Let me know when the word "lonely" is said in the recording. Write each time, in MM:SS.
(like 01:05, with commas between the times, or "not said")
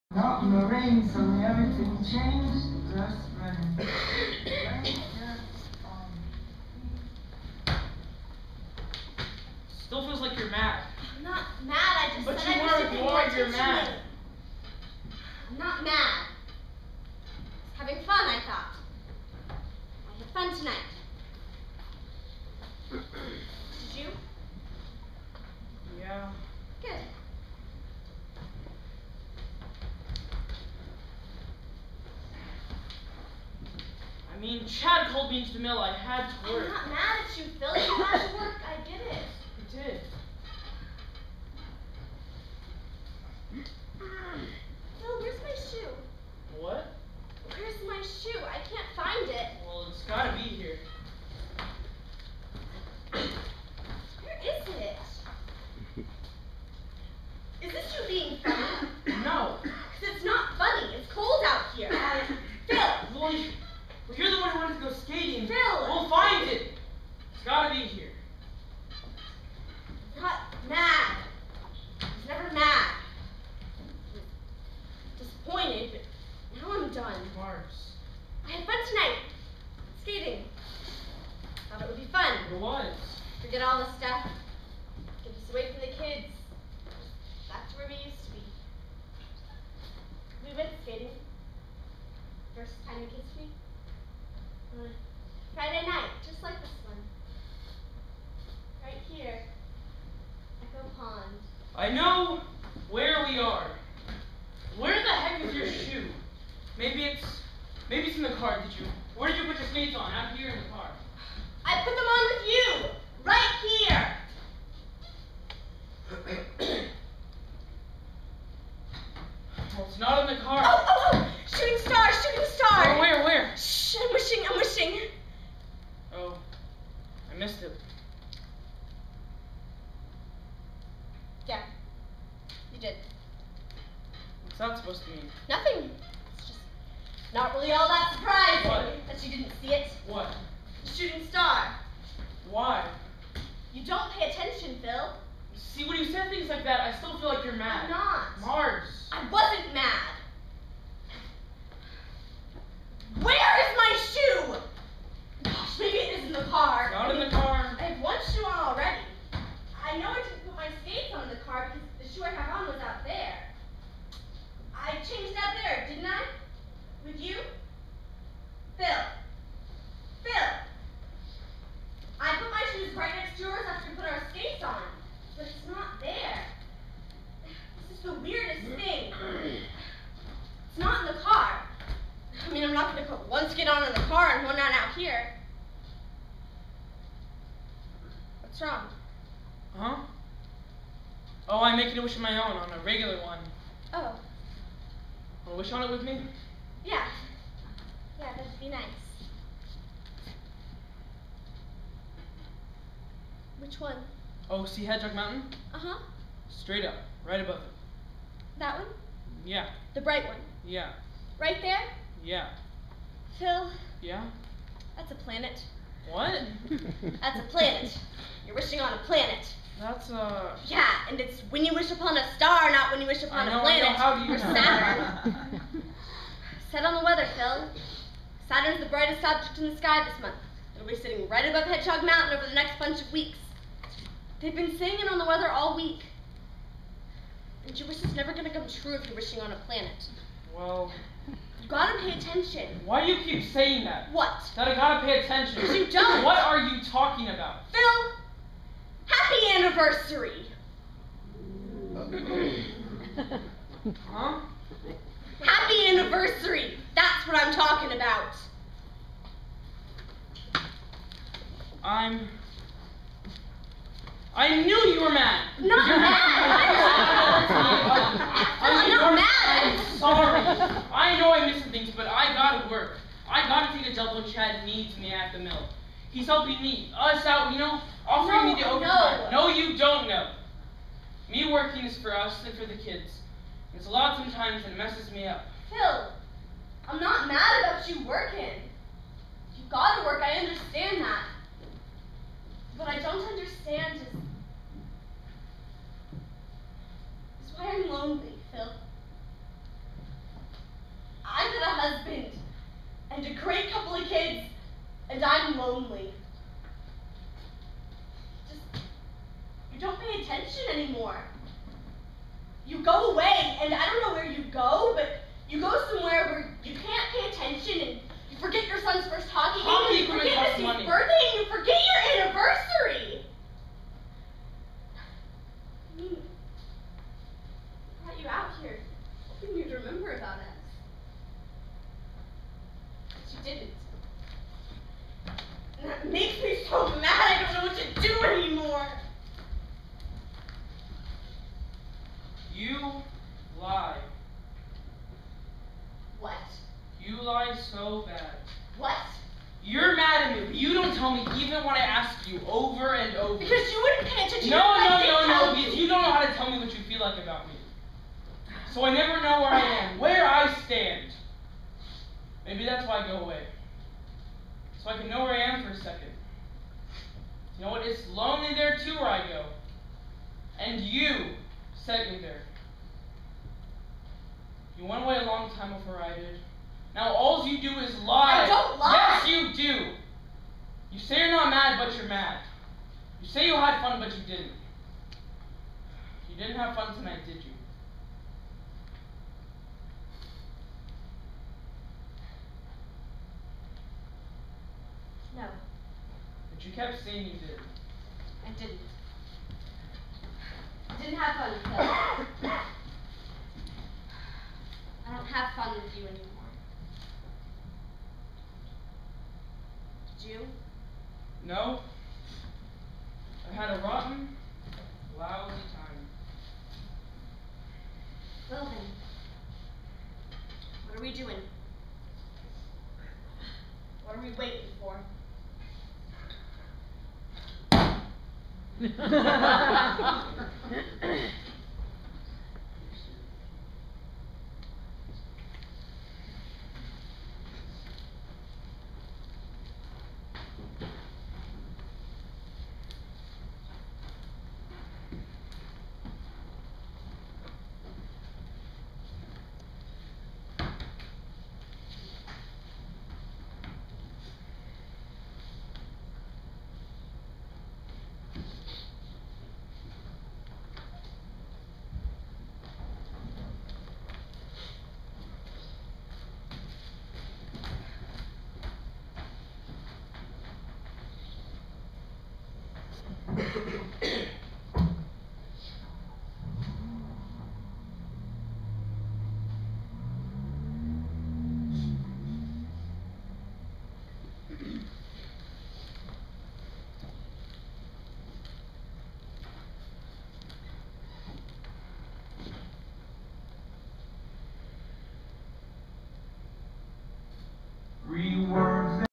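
05:05, 06:08.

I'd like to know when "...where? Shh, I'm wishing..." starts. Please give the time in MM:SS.
02:03.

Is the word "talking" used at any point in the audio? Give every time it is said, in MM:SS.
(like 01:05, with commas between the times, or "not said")
04:06, 04:17.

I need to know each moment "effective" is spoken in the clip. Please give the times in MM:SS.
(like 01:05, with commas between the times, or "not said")
not said.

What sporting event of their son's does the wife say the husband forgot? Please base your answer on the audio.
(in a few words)
First hockey game.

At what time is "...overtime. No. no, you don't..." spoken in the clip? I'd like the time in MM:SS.
04:38.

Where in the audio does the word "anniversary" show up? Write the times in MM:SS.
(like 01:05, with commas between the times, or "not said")
04:09, 04:15, 05:22.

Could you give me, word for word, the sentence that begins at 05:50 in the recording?
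You don't tell me even when I ask you over and over.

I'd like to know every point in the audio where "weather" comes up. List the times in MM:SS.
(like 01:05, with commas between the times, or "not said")
03:47, 03:55.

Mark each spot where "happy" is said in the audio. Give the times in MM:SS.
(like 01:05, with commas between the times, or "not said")
04:09, 04:15.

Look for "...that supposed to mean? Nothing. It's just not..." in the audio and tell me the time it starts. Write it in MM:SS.
02:14.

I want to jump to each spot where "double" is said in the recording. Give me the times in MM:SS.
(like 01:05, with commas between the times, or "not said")
04:34.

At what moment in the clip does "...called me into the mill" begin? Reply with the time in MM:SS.
00:35.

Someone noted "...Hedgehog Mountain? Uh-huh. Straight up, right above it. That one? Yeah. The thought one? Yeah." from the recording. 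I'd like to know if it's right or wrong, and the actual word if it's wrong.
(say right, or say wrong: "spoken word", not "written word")
wrong: "bright", not "thought".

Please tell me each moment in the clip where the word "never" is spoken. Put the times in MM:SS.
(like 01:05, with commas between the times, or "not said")
03:58, 05:58.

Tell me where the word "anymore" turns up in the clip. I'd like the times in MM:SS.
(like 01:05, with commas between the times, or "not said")
05:10, 05:38, 06:46.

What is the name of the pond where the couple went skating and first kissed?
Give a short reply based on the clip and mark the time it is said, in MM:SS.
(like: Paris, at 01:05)
Echo Pond, at 01:40.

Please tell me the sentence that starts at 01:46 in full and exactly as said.
Maybe it's maybe it's in the car.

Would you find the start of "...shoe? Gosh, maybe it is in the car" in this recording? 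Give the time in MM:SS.
02:34.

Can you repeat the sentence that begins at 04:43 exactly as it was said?
It's a lot sometimes and it messes me up.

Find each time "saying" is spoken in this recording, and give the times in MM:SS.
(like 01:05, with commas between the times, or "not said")
03:54, 04:03, 06:37.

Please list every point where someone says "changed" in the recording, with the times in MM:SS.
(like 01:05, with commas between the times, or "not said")
00:02, 02:44.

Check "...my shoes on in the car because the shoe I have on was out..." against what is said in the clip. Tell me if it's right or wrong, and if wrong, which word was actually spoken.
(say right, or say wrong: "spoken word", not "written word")
wrong: "skates", not "shoes".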